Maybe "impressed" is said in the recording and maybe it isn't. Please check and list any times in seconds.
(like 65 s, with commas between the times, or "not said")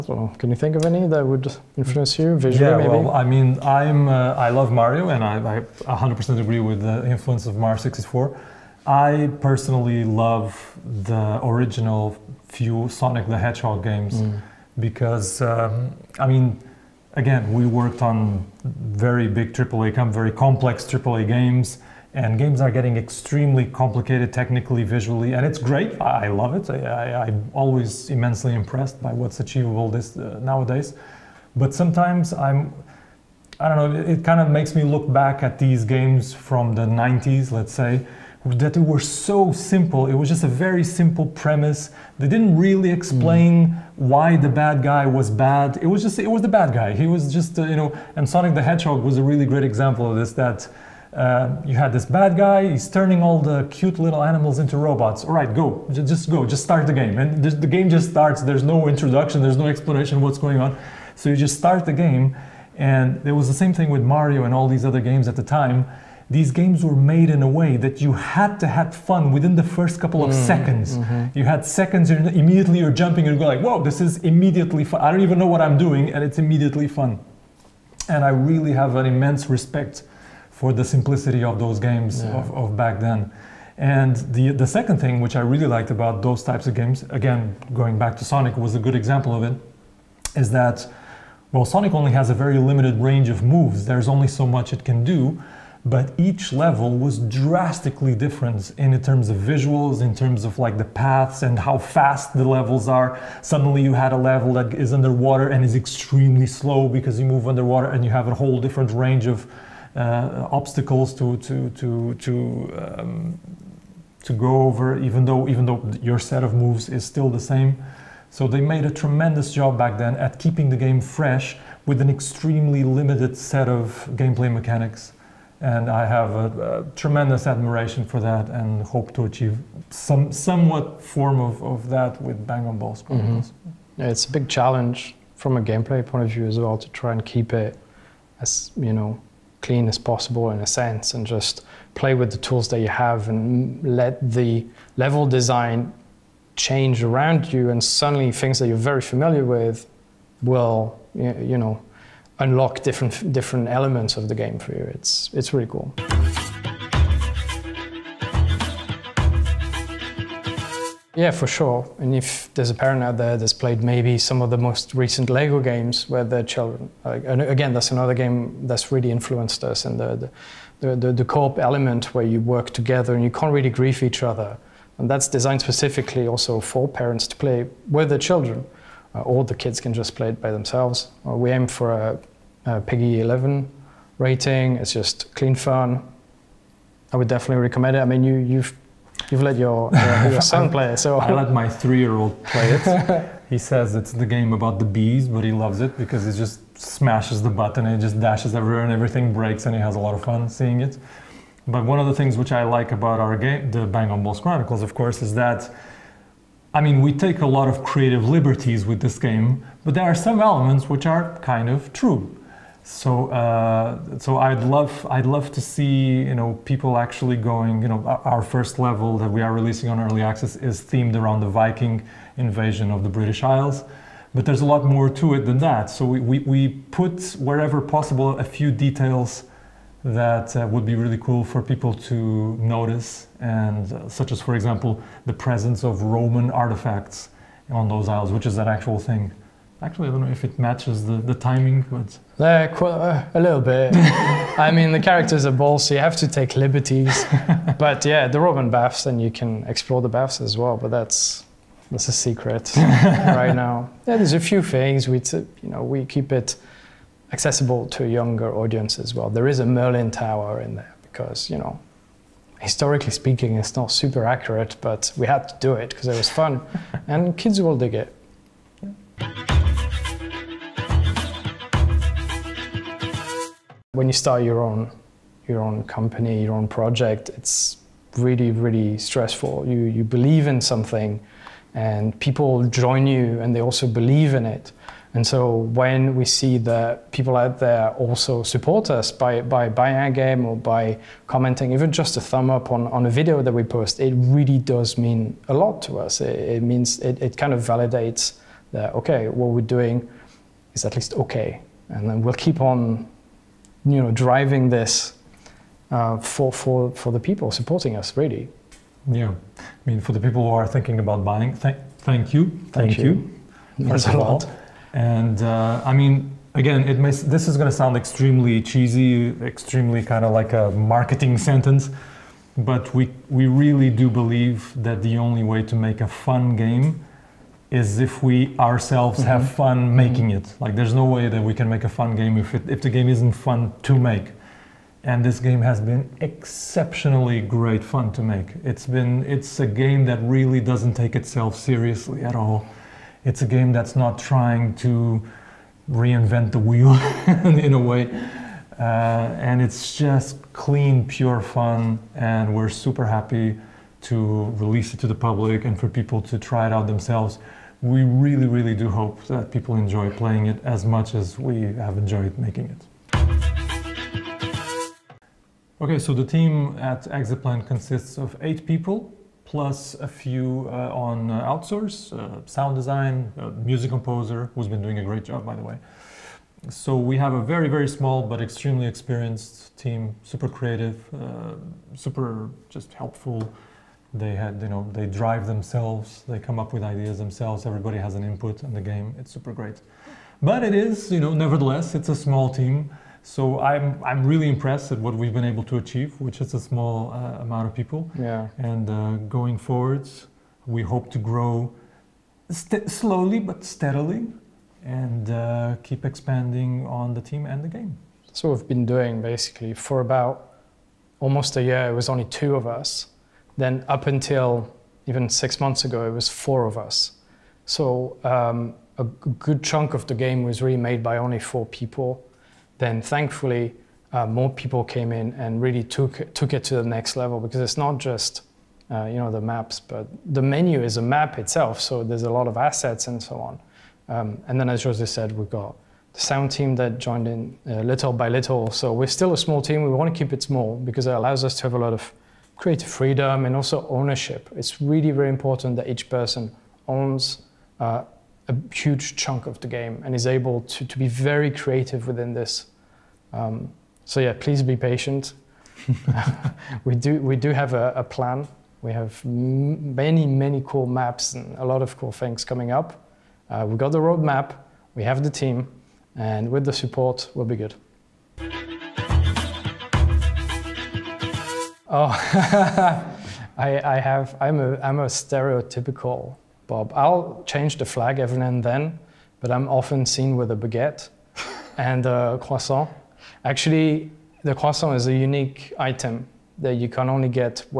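28 s, 394 s.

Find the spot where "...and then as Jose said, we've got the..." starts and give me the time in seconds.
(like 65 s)
434 s.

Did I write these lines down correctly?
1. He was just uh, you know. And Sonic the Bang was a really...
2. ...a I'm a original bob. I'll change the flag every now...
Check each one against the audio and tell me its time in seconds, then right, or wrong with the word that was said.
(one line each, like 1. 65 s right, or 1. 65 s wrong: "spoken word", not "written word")
1. 46 s wrong: "Hedgehog", not "Bang"
2. 474 s wrong: "stereotypical", not "original".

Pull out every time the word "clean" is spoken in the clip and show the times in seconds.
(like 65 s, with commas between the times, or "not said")
139 s, 185 s, 350 s.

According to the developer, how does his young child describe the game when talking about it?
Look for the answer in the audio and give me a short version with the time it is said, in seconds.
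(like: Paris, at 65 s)
the game about the bees, at 194 s.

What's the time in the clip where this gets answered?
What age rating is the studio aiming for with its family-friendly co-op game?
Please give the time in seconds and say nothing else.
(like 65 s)
182 s.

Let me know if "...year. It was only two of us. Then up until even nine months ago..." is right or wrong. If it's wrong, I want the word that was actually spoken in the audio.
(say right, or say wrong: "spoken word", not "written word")
wrong: "six", not "nine".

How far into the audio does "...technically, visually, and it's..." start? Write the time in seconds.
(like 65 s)
24 s.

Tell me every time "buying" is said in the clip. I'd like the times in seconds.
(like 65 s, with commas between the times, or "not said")
289 s, 311 s.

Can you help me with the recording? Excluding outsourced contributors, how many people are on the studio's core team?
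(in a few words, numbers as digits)
8.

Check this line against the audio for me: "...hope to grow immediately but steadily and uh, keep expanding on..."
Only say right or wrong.
wrong.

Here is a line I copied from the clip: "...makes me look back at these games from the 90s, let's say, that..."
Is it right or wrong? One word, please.
right.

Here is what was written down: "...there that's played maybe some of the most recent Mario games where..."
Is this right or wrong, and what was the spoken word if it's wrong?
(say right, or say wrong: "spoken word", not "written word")
wrong: "Lego", not "Mario".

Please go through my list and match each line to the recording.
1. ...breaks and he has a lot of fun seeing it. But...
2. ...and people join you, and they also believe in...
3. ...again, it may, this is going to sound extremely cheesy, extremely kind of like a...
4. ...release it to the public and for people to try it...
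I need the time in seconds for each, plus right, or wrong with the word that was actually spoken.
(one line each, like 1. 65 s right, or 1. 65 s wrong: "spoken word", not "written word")
1. 199 s right
2. 281 s right
3. 316 s right
4. 354 s right.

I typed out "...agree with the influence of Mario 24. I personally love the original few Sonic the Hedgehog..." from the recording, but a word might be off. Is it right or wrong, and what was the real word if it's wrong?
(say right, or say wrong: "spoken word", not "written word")
wrong: "64", not "24".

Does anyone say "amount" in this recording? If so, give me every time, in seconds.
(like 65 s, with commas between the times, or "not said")
397 s.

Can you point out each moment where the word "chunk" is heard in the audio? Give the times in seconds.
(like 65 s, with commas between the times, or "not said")
419 s, 449 s.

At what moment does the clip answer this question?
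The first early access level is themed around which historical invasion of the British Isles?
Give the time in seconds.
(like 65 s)
221 s.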